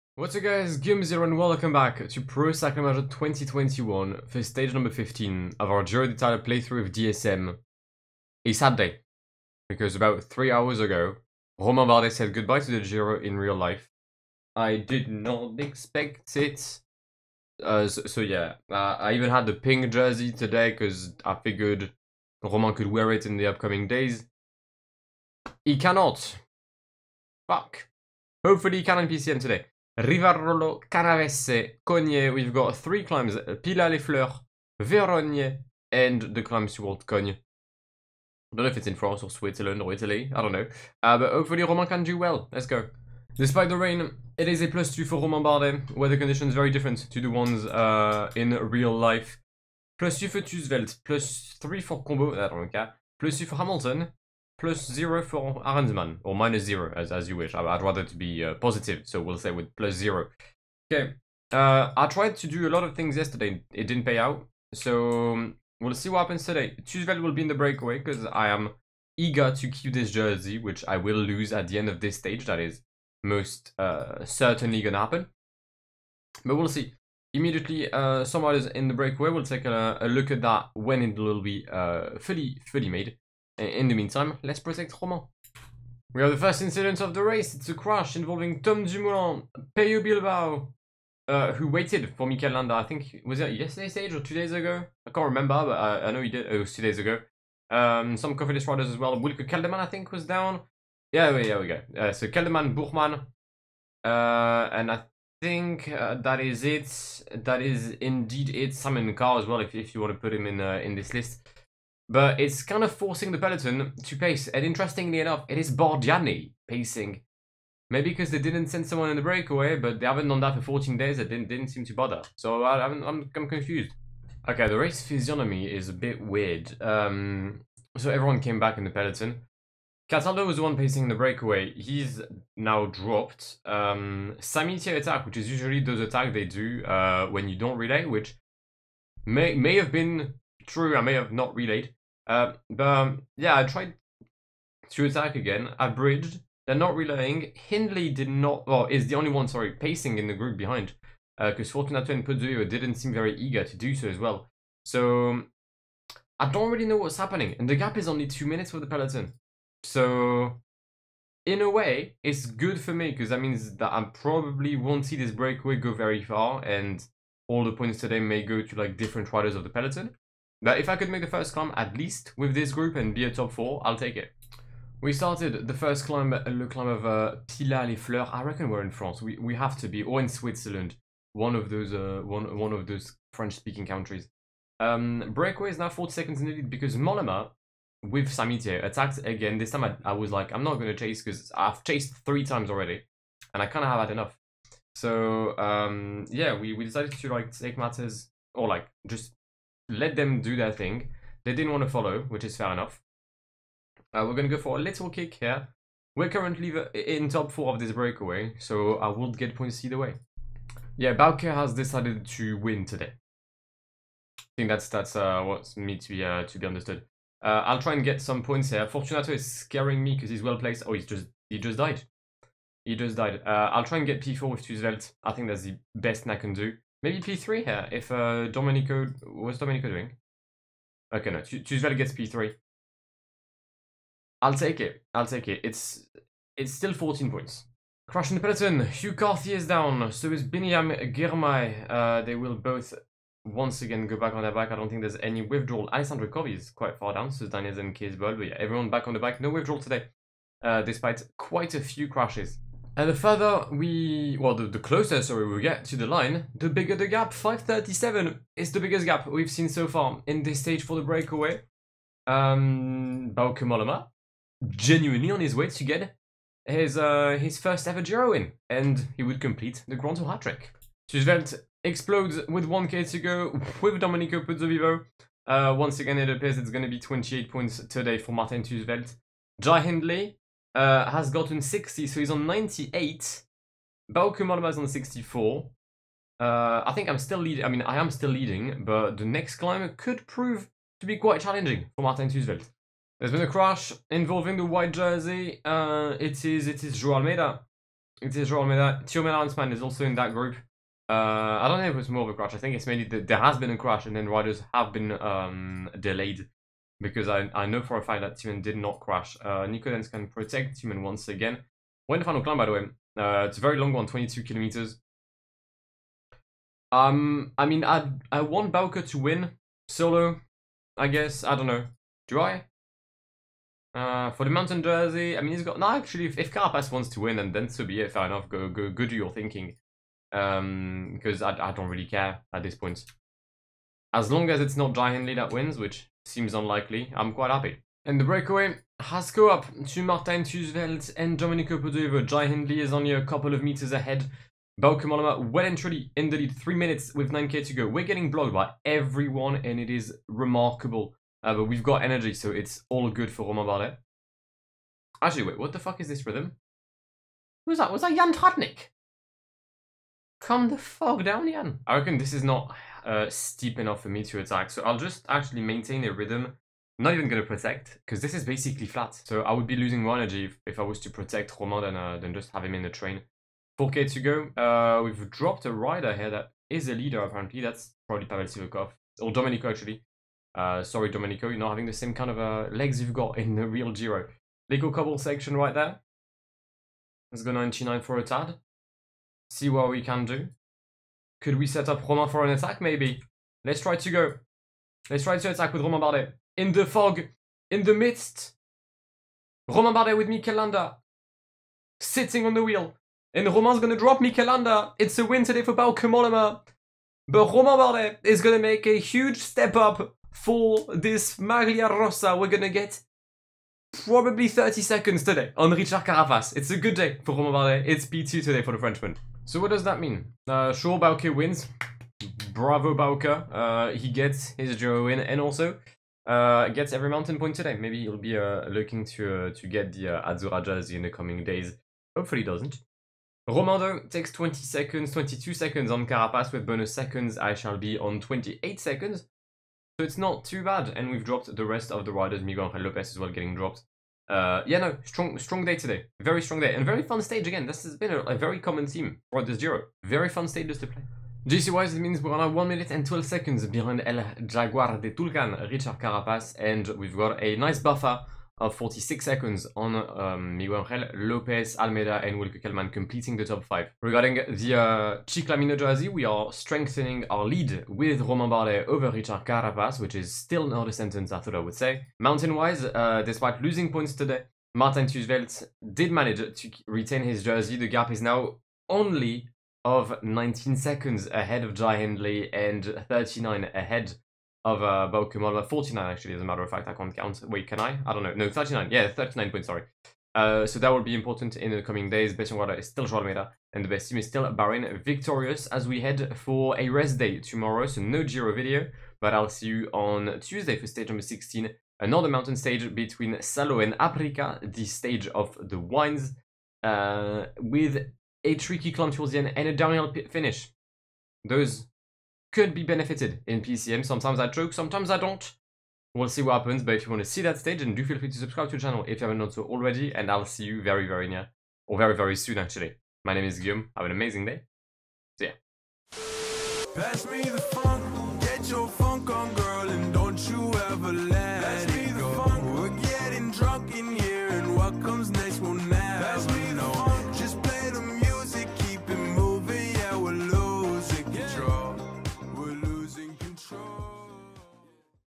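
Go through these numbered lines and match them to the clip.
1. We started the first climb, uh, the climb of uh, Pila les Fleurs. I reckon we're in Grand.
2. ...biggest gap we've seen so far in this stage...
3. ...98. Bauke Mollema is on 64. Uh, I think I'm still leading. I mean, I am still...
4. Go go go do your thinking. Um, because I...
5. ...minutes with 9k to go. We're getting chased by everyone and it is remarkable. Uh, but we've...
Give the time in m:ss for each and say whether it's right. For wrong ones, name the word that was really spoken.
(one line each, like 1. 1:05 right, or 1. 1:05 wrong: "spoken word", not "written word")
1. 2:55 wrong: "France", not "Grand"
2. 4:18 right
3. 4:42 right
4. 5:28 right
5. 5:46 wrong: "blocked", not "chased".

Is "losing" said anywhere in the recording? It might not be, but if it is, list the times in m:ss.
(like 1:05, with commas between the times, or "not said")
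6:09, 7:53.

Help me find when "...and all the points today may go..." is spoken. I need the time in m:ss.
2:46.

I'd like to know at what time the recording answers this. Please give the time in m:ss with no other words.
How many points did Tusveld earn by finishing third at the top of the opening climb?
3:56.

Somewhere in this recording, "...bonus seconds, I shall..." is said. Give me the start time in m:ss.
7:16.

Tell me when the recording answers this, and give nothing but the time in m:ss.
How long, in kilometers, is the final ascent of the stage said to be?
5:14.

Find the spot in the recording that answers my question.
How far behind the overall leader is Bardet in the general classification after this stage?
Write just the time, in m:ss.
7:32.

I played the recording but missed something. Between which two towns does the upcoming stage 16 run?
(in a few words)
Salo and Aprica.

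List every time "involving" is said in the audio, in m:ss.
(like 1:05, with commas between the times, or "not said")
1:28, 4:54.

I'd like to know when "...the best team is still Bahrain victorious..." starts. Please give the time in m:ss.
8:13.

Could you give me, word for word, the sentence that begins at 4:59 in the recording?
Thymen Arensman is also in that group.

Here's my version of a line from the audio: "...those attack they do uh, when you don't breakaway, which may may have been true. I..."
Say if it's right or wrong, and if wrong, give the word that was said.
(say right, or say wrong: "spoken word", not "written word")
wrong: "relay", not "breakaway".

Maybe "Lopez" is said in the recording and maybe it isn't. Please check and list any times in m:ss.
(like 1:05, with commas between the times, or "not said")
7:22, 7:41.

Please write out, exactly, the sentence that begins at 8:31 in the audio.
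Those could be benefited in PCM.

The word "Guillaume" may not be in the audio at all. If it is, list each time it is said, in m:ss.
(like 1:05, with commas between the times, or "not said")
0:00, 8:43.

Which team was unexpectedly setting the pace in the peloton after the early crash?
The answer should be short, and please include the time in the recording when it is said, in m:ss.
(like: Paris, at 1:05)
Bardiani, at 1:55.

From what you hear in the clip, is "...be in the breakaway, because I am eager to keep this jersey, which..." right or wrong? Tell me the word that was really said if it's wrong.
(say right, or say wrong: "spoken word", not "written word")
right.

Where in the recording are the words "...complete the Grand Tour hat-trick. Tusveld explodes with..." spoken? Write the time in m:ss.
4:29.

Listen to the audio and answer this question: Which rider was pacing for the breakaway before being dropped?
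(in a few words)
Cataldo.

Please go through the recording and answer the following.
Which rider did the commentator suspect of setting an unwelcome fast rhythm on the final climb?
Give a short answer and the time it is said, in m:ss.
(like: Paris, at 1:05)
Jan Tratnik, at 5:58.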